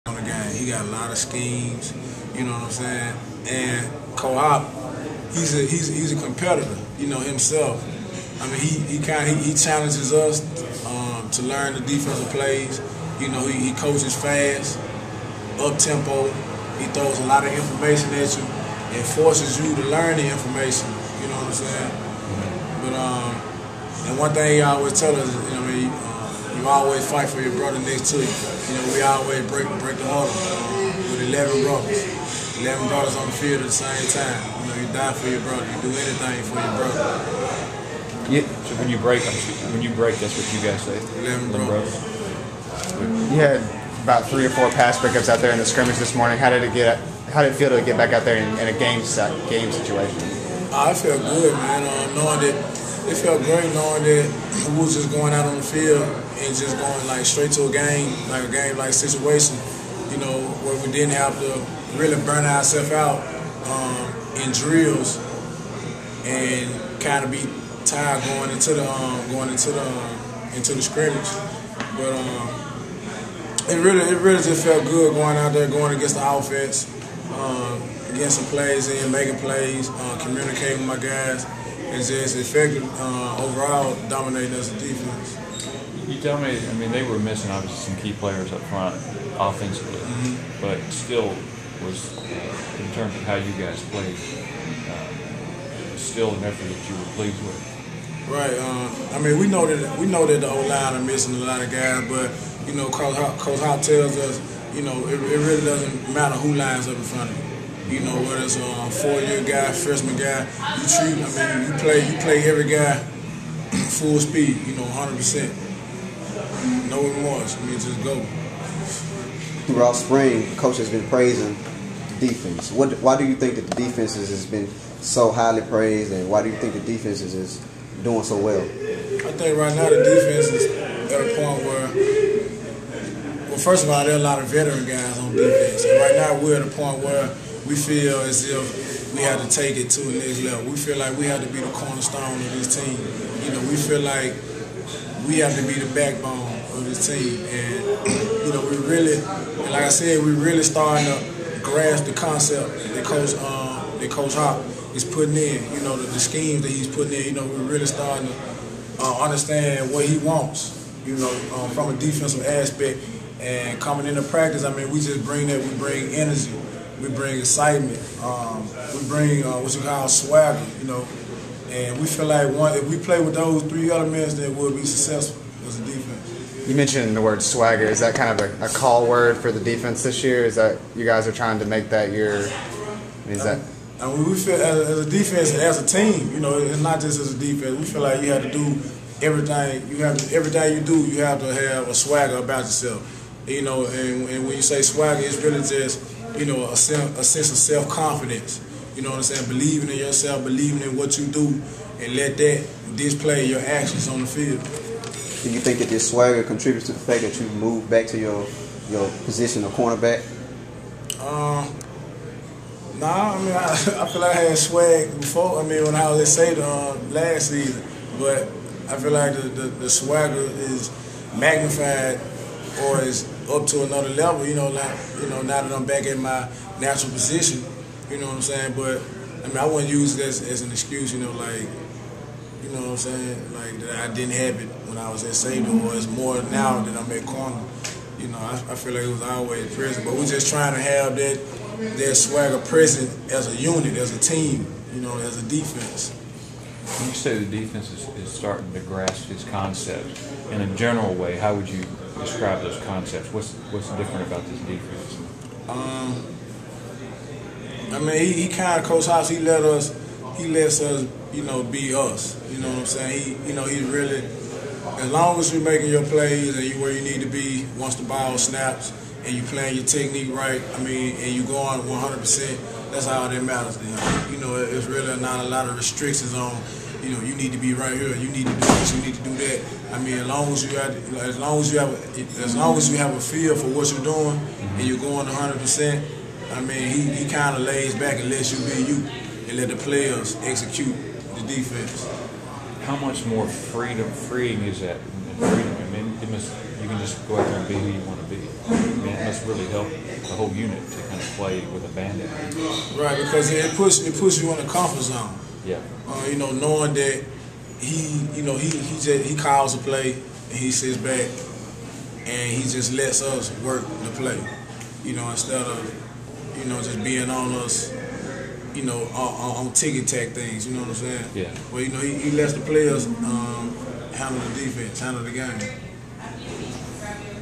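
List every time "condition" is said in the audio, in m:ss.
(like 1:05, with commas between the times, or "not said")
not said.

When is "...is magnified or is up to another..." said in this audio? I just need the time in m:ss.
3:40.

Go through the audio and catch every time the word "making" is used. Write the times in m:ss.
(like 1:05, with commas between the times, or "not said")
1:19, 4:25.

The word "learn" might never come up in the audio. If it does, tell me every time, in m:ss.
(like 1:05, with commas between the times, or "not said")
0:11, 0:19.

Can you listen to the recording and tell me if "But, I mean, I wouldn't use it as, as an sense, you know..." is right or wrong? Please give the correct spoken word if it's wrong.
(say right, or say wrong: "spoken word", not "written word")
wrong: "excuse", not "sense".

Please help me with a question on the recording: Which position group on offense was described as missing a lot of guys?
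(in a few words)
O line.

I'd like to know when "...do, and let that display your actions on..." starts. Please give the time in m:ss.
3:21.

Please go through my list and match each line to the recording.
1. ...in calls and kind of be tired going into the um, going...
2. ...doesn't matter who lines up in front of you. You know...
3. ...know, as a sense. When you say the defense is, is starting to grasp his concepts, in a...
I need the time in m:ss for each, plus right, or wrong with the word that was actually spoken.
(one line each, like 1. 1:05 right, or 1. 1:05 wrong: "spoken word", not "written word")
1. 1:04 wrong: "drills", not "calls"
2. 1:45 right
3. 4:05 wrong: "defense", not "sense".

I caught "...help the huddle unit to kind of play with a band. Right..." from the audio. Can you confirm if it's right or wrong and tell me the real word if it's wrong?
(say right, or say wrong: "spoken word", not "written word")
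wrong: "whole", not "huddle".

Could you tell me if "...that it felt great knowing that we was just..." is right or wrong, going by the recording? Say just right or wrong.
right.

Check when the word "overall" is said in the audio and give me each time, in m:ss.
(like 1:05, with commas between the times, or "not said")
1:23.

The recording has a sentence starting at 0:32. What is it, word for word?
11 brothers on the field at the same time.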